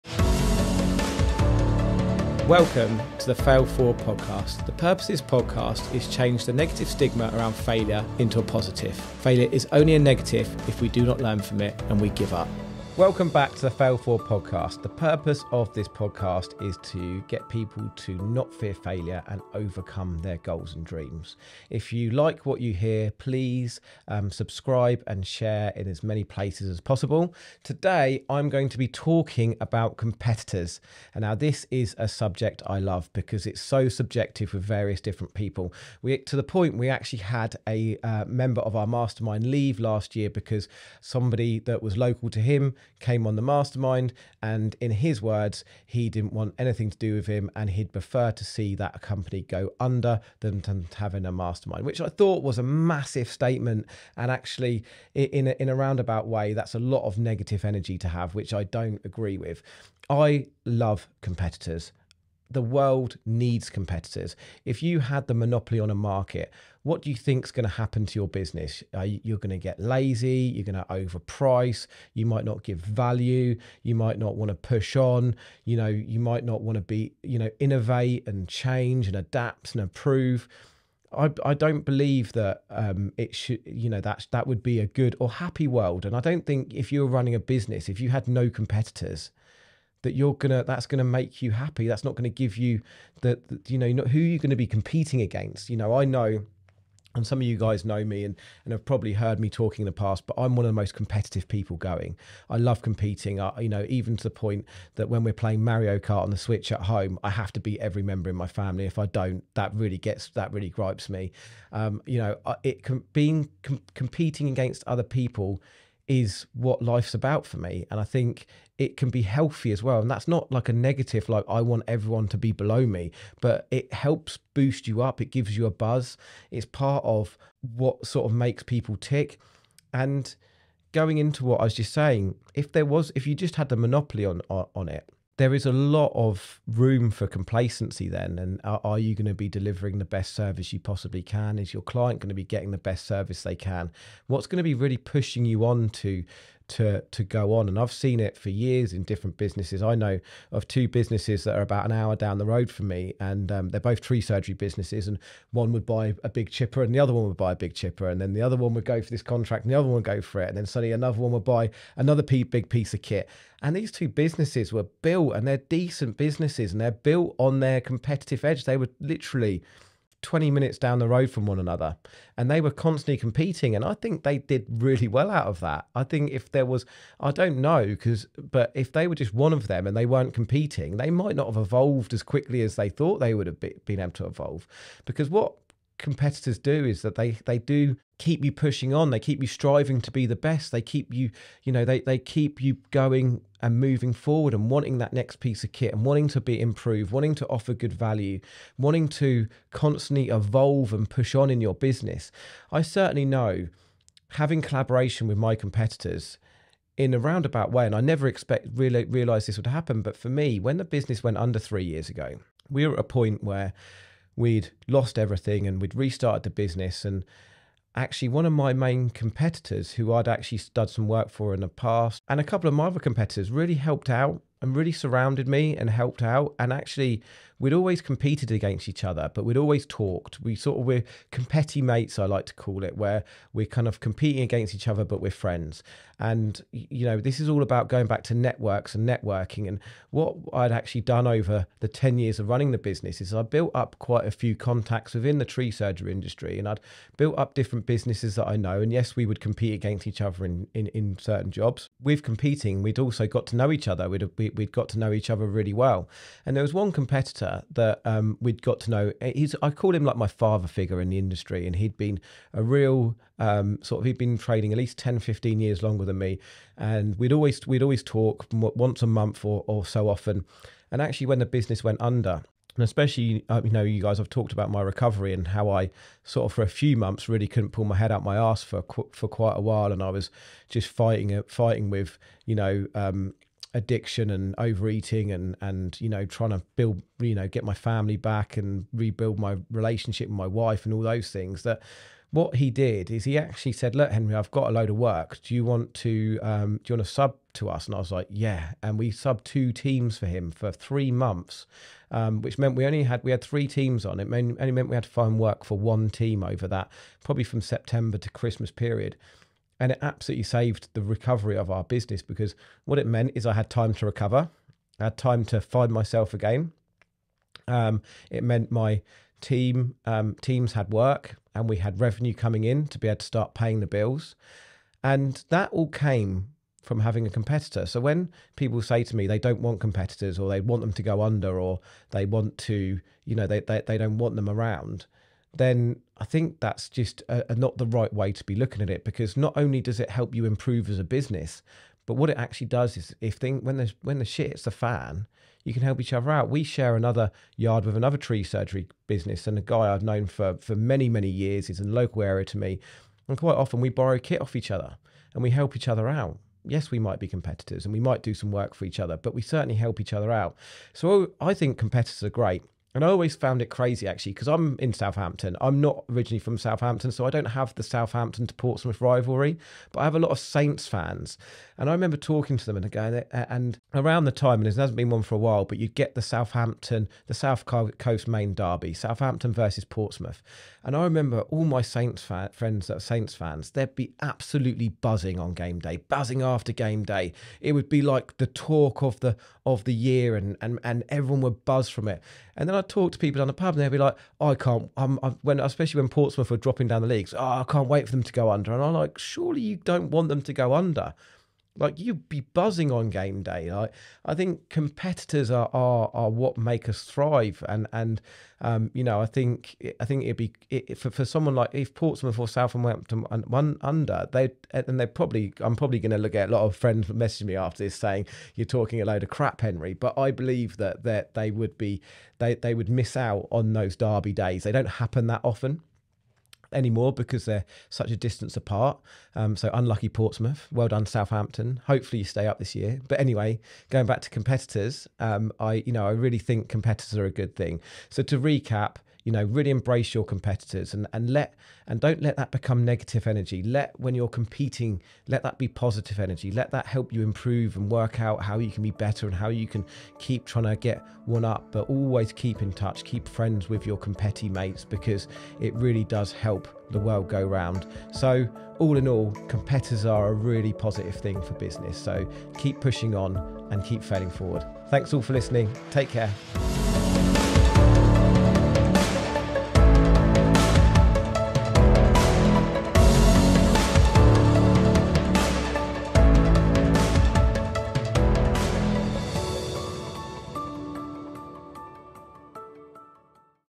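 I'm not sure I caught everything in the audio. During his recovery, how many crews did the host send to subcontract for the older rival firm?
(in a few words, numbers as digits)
2.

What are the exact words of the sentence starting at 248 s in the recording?
And yes, we would compete against each other in in, in certain jobs.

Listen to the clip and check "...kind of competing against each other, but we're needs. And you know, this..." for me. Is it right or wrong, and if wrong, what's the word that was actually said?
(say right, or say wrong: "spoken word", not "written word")
wrong: "friends", not "needs".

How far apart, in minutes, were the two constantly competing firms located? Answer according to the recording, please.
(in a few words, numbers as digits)
20 minutes.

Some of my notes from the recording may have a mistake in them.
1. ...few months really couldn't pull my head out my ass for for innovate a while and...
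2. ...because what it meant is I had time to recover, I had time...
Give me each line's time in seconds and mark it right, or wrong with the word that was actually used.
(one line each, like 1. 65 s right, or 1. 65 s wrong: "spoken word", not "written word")
1. 276 s wrong: "quite", not "innovate"
2. 312 s right.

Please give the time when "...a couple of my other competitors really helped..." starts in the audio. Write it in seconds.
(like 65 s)
222 s.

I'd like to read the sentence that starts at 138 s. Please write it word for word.
And are, are you going to be delivering the best service you possibly can?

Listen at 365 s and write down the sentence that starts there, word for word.
I'm not originally from Southampton, so I don't have the Southampton to Portsmouth rivalry, but I have a lot of Saints fans.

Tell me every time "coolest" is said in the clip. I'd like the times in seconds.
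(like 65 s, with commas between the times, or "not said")
not said.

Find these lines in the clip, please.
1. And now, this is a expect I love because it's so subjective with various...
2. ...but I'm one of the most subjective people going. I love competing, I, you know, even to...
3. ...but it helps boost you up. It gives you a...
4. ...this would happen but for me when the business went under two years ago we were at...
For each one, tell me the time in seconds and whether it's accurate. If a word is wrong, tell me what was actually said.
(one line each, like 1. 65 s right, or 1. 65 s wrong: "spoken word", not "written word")
1. 31 s wrong: "subject", not "expect"
2. 100 s wrong: "competitive", not "subjective"
3. 123 s right
4. 209 s wrong: "three", not "two".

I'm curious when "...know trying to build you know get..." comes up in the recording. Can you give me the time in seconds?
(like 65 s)
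286 s.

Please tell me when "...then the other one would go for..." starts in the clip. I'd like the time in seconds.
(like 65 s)
158 s.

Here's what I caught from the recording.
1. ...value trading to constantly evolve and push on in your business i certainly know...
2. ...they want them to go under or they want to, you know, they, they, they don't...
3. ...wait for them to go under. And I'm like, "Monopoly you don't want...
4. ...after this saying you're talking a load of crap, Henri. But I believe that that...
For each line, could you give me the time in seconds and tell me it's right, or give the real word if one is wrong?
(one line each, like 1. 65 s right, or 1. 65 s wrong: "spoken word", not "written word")
1. 197 s wrong: "wanting", not "trading"
2. 330 s right
3. 397 s wrong: "Surely", not "Monopoly"
4. 417 s right.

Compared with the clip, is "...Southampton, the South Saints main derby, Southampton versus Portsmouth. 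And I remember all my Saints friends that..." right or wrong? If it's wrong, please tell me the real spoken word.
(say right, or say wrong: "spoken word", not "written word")
wrong: "Coast", not "Saints".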